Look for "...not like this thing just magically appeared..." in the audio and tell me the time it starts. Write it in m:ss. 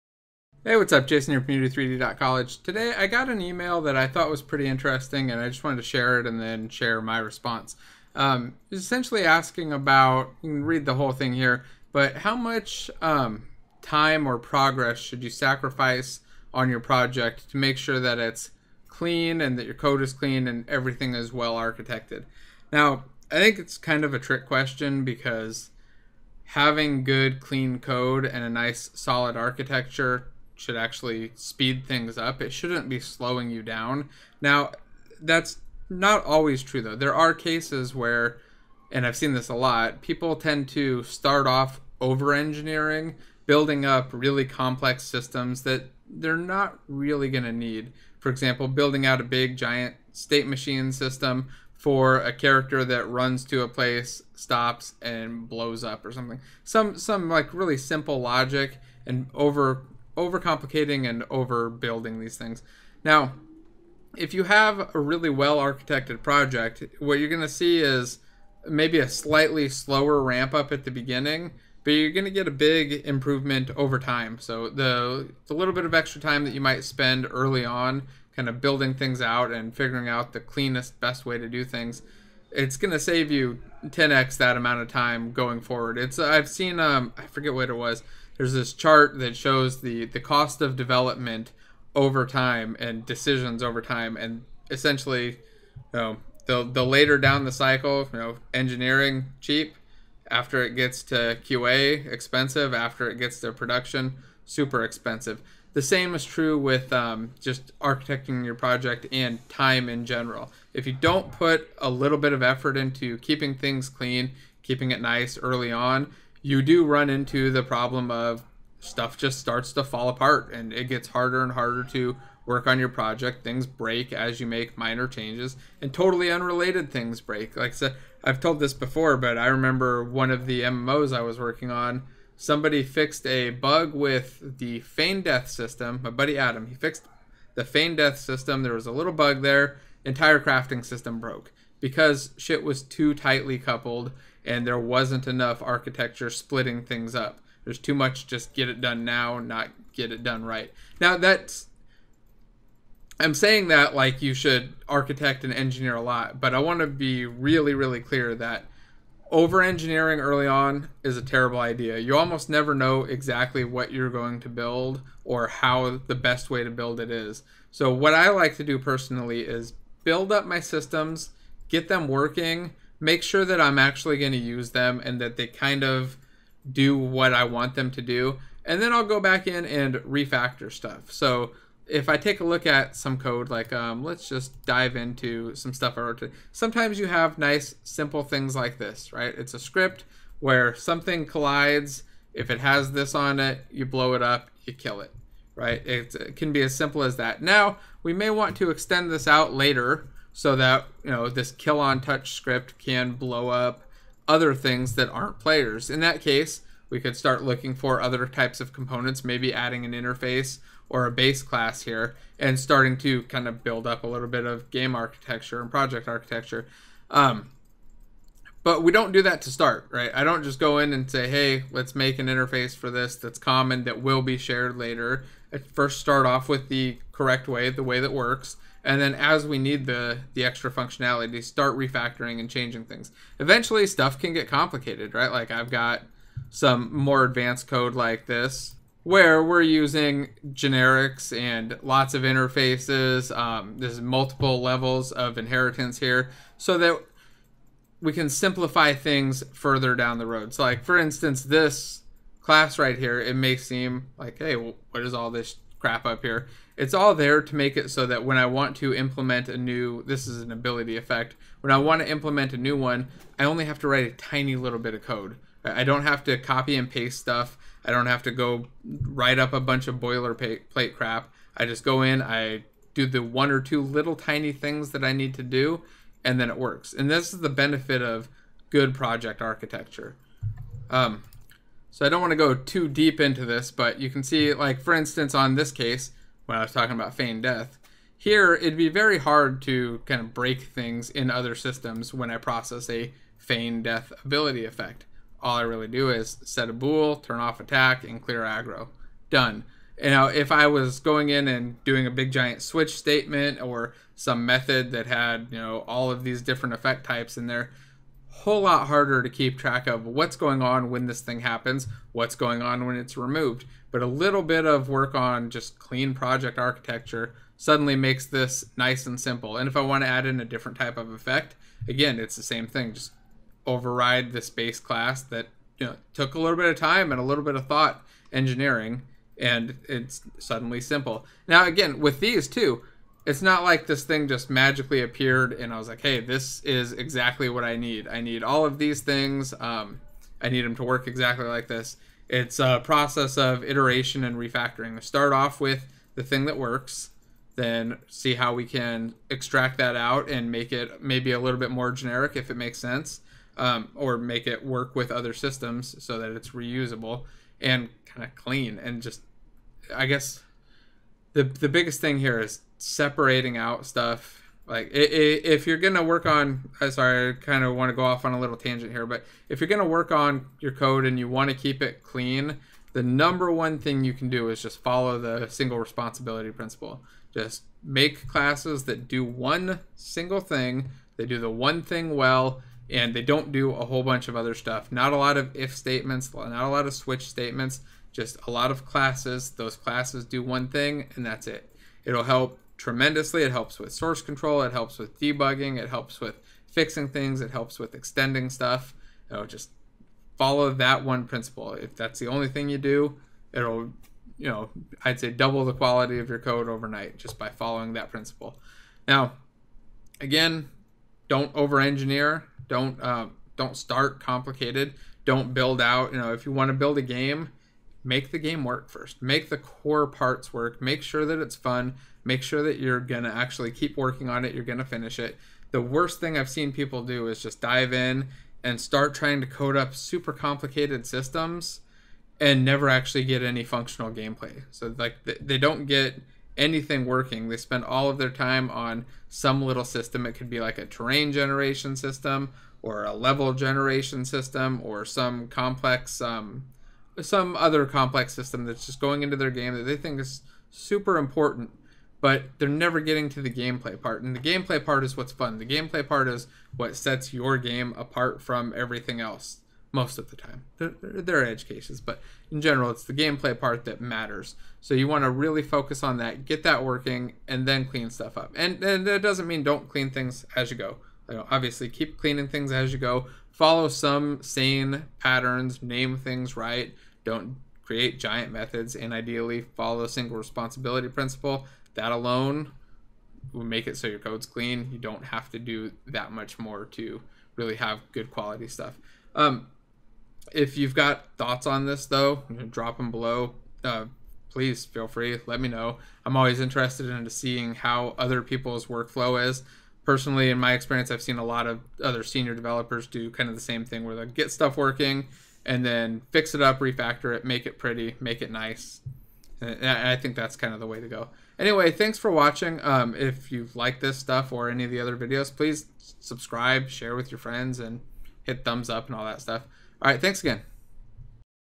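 5:33.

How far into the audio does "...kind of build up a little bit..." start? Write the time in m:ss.
3:33.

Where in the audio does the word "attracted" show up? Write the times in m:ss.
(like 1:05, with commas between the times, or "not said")
not said.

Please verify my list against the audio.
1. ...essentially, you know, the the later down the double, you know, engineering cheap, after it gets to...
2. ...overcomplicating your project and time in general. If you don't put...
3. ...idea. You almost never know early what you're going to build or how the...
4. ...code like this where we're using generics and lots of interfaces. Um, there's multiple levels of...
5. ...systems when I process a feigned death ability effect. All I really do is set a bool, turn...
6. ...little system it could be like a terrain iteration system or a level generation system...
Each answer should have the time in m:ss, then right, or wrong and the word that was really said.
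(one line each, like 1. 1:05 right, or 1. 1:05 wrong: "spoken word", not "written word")
1. 1:34 wrong: "cycle", not "double"
2. 1:47 wrong: "architecting", not "overcomplicating"
3. 2:41 wrong: "exactly", not "early"
4. 3:57 right
5. 4:51 right
6. 7:19 wrong: "generation", not "iteration".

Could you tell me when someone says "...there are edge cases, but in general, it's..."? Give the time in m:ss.
7:41.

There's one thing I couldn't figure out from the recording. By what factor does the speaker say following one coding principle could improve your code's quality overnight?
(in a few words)
double.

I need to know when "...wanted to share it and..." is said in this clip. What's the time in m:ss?
0:05.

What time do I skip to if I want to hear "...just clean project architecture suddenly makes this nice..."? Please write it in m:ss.
5:15.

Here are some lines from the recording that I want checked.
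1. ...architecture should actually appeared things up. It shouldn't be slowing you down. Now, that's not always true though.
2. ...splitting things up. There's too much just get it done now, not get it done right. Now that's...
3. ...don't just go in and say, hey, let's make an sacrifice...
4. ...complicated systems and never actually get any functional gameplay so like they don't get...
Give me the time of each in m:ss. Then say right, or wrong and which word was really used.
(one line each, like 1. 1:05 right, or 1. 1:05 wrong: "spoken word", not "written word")
1. 0:29 wrong: "speed", not "appeared"
2. 2:26 right
3. 3:40 wrong: "interface", not "sacrifice"
4. 7:10 right.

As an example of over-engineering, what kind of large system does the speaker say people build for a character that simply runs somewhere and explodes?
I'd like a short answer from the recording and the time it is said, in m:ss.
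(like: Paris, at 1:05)
state machine system, at 0:50.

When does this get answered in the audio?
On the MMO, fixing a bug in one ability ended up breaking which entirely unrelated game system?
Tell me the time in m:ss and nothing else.
2:20.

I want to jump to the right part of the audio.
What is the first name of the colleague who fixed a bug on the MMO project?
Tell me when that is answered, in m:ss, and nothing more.
2:16.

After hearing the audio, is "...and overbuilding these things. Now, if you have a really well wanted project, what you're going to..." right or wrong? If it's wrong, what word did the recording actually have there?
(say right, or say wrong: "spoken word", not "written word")
wrong: "architected", not "wanted".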